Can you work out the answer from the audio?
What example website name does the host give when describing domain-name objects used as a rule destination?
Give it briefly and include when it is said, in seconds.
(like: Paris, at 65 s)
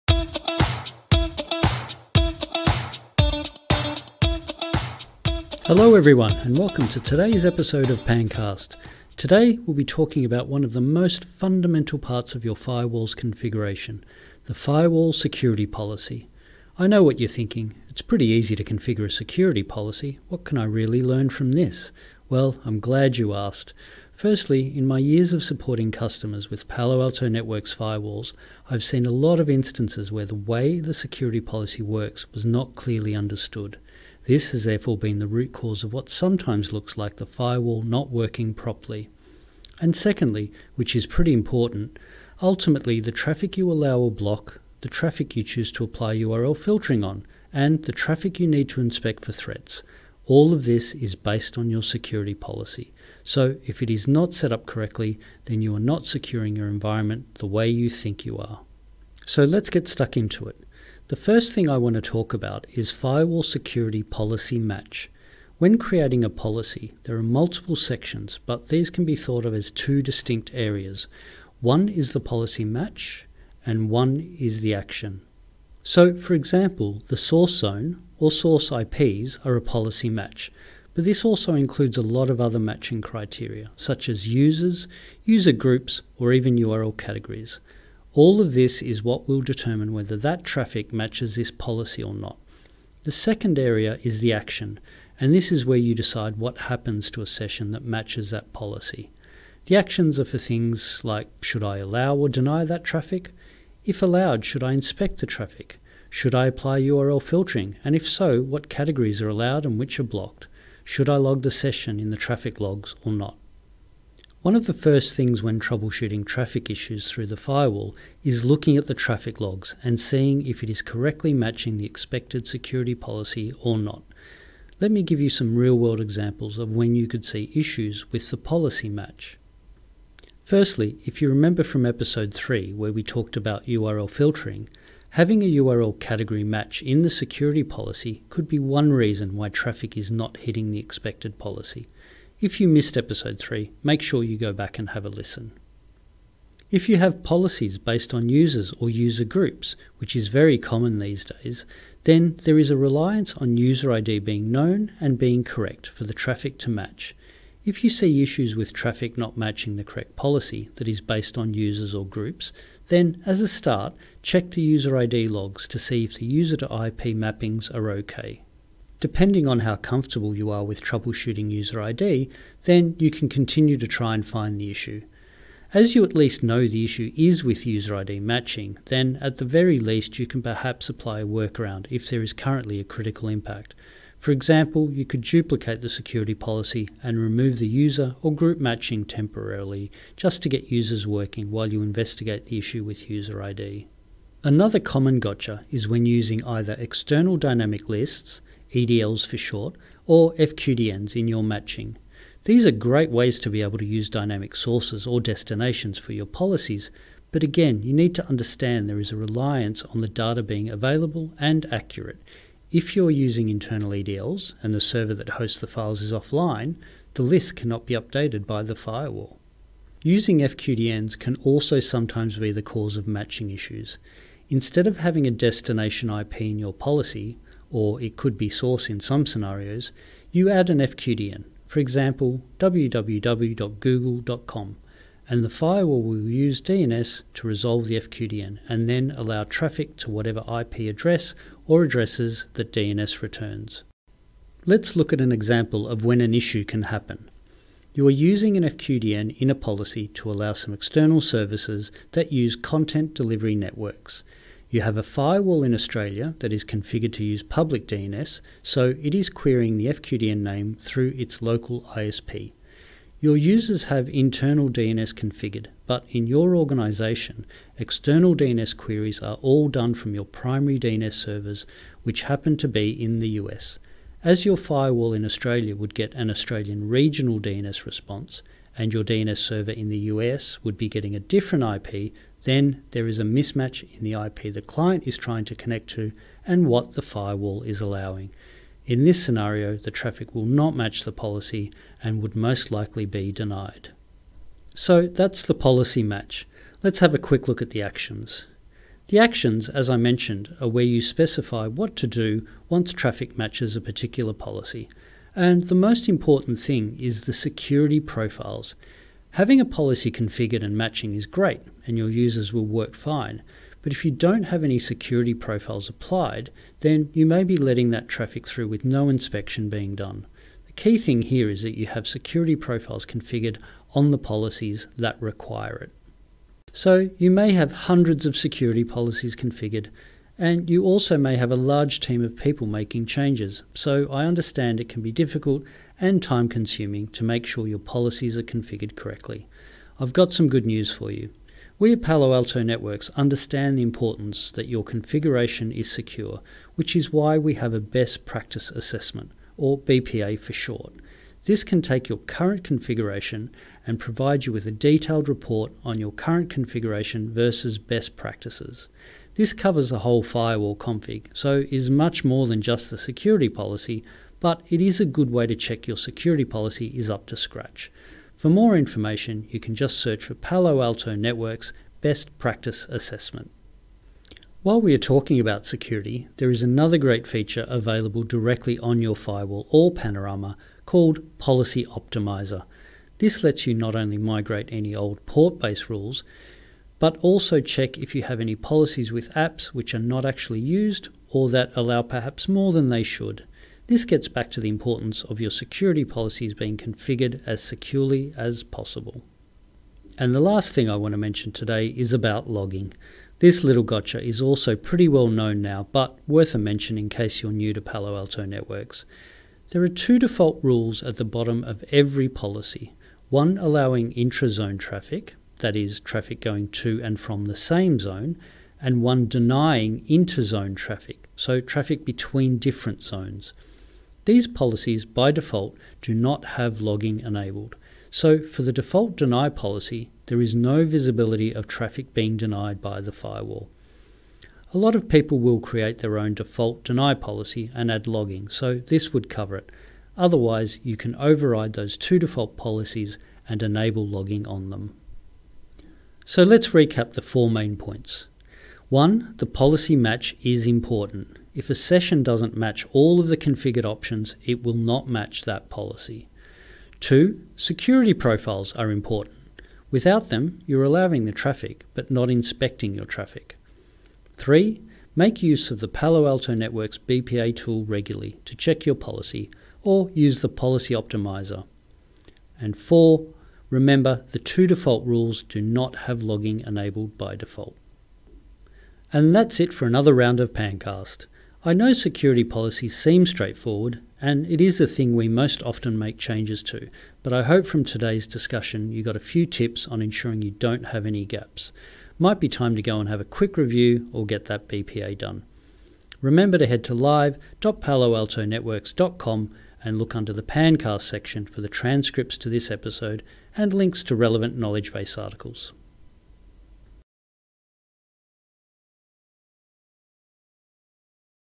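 www.google.com, at 232 s.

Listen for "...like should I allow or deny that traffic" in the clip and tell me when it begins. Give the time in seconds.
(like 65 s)
101 s.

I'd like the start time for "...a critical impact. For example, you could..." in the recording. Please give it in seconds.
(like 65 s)
182 s.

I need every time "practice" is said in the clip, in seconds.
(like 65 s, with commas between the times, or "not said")
348 s, 358 s, 372 s.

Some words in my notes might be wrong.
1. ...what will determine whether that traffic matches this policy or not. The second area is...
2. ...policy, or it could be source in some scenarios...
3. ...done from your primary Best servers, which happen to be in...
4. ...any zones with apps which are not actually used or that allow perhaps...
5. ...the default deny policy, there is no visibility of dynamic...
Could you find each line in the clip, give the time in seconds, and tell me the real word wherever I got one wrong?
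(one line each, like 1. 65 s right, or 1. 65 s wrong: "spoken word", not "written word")
1. 89 s right
2. 226 s right
3. 269 s wrong: "DNS", not "Best"
4. 388 s wrong: "policies", not "zones"
5. 428 s wrong: "traffic", not "dynamic".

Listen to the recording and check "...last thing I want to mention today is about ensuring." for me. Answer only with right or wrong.
wrong.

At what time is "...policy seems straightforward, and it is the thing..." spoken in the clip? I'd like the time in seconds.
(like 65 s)
482 s.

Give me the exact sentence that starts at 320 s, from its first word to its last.
The key thing here is that you have security profiles configured on the policies that require it.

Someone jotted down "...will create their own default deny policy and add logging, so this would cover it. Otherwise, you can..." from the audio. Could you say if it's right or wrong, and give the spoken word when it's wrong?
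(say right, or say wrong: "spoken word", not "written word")
right.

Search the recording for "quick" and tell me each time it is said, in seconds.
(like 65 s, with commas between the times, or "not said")
297 s, 493 s.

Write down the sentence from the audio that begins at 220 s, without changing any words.
Using FQDNs can also sometimes be the cause of matching issues.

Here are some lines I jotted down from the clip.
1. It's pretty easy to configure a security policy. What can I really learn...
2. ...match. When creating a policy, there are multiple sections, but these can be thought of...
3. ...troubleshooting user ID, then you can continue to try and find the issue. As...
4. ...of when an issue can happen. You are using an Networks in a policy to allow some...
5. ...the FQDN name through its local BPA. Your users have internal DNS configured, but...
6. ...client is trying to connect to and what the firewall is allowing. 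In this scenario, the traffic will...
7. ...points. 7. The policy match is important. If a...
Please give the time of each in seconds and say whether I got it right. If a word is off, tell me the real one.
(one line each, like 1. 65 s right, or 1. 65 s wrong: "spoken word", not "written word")
1. 17 s right
2. 64 s right
3. 170 s right
4. 245 s wrong: "FQDN", not "Networks"
5. 259 s wrong: "ISP", not "BPA"
6. 284 s right
7. 447 s wrong: "1", not "7".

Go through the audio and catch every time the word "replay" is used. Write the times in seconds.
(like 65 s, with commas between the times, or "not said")
not said.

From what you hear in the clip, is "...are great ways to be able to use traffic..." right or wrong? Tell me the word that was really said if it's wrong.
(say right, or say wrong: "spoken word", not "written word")
wrong: "dynamic", not "traffic".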